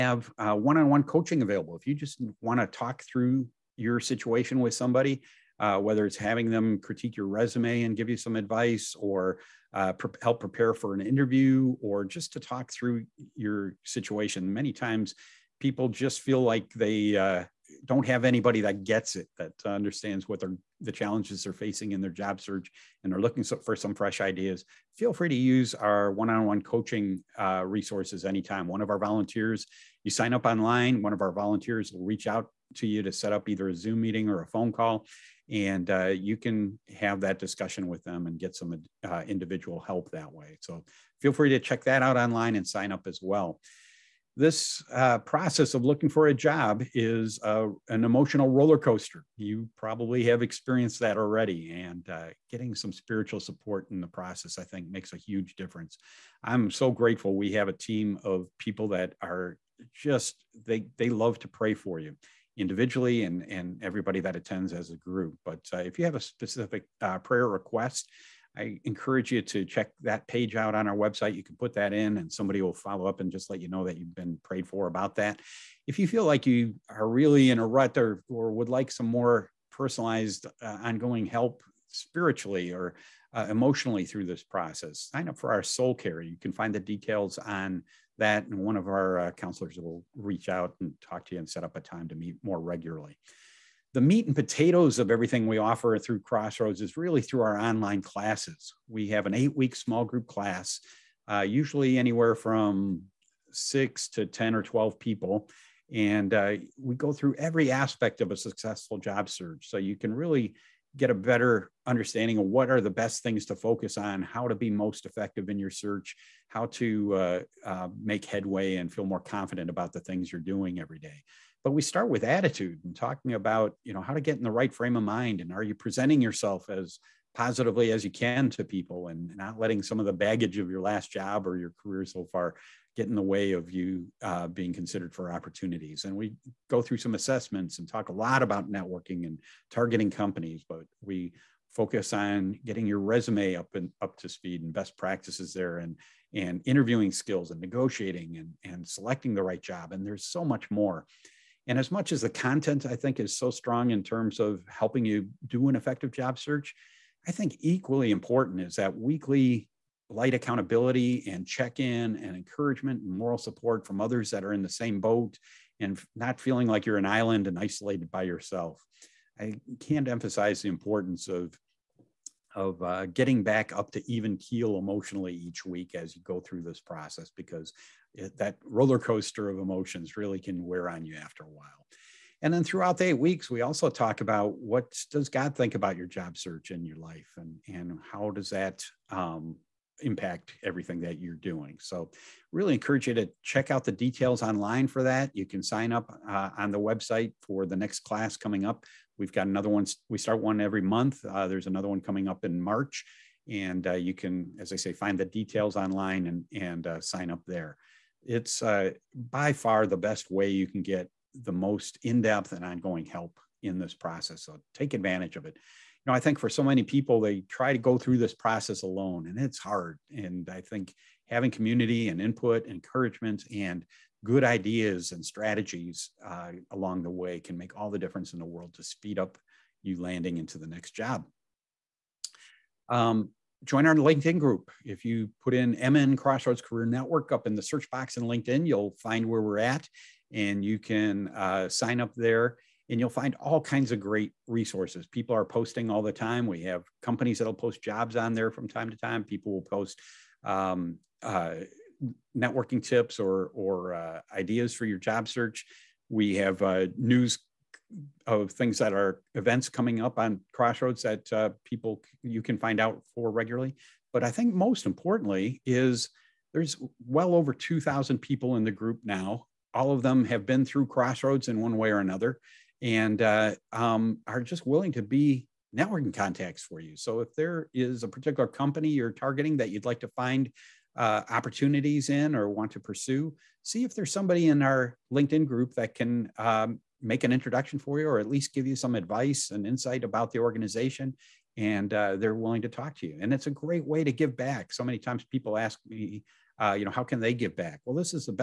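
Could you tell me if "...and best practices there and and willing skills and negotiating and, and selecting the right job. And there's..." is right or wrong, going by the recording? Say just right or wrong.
wrong.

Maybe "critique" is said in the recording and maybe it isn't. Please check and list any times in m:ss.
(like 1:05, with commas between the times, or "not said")
0:06.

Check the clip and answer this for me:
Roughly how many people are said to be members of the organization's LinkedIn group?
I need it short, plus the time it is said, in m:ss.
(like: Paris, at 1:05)
over 2,000, at 4:27.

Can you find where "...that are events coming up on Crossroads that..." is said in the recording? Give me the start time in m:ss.
4:18.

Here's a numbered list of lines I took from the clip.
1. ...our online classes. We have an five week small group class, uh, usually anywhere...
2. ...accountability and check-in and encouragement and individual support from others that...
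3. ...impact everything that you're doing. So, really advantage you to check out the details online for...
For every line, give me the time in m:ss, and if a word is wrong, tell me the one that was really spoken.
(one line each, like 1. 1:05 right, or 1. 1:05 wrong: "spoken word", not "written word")
1. 1:37 wrong: "eight", not "five"
2. 2:40 wrong: "moral", not "individual"
3. 3:10 wrong: "encourage", not "advantage".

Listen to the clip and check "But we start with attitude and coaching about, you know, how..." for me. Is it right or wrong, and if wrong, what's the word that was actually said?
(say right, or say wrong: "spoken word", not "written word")
wrong: "talking", not "coaching".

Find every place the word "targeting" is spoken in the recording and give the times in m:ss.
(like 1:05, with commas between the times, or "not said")
2:19, 4:39.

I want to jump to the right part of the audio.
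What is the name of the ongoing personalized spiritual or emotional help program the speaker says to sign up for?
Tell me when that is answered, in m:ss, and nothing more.
1:25.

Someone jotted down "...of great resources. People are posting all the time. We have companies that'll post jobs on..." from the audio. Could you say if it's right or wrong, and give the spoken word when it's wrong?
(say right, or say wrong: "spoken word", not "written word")
right.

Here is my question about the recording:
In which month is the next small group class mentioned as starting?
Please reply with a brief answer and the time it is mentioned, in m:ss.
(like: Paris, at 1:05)
March, at 3:22.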